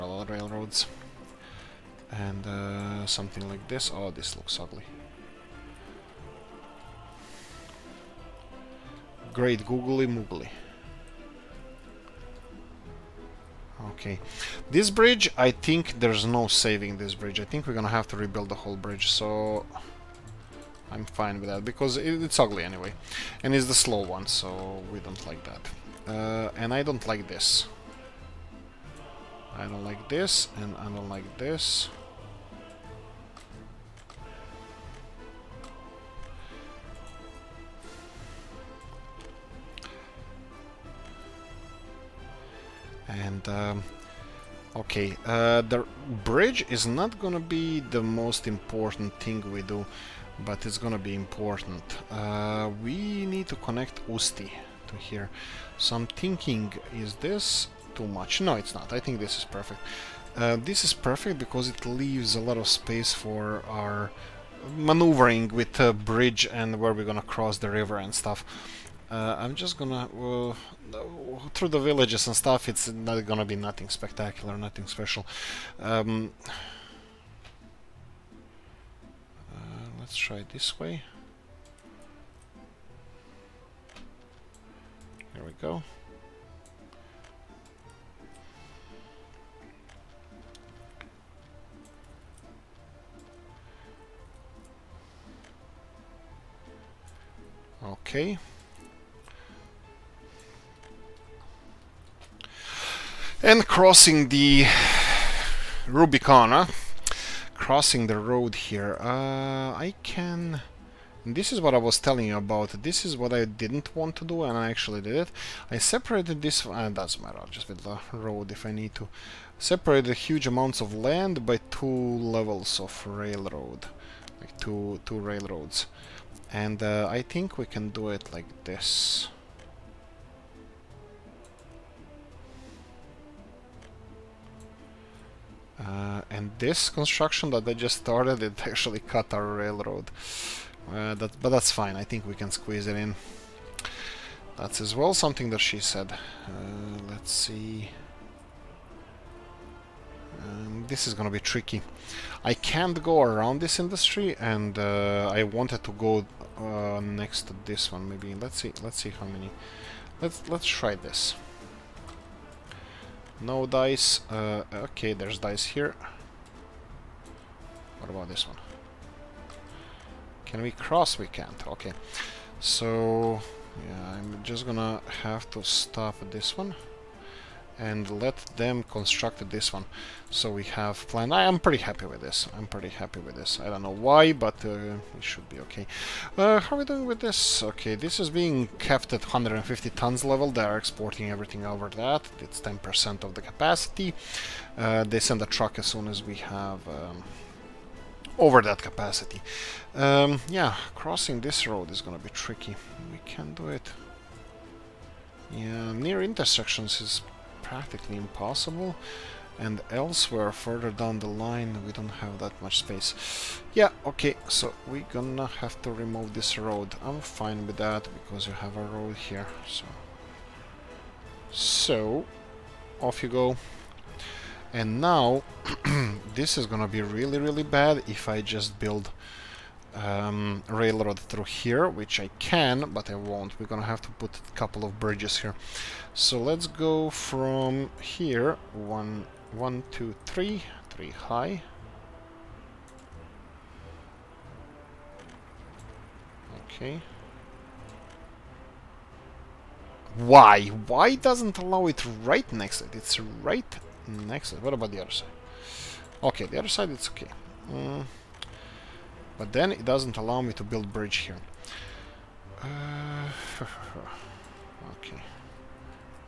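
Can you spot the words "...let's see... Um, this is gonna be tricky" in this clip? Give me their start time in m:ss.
2:27.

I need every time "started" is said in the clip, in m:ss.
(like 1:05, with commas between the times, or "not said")
2:17.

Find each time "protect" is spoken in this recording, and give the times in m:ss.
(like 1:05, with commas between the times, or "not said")
not said.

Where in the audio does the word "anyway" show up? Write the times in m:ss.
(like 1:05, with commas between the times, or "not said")
0:22.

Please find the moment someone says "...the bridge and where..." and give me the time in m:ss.
1:05.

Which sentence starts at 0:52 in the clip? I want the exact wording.
Uh, we need to connect Usti to here.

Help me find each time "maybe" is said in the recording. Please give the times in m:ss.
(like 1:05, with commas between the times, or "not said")
2:38.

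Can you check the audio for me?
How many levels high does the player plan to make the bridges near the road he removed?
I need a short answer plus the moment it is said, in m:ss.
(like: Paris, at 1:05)
3, at 4:00.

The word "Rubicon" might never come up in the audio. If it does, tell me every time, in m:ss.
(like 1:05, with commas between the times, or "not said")
1:45.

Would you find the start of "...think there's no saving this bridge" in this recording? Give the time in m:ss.
0:15.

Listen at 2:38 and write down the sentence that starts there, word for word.
Let's see, let's see how many...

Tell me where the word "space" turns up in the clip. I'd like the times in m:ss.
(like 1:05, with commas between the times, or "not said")
1:02, 3:32.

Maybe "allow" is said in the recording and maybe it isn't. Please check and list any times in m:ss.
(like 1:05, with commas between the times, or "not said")
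4:11, 4:20.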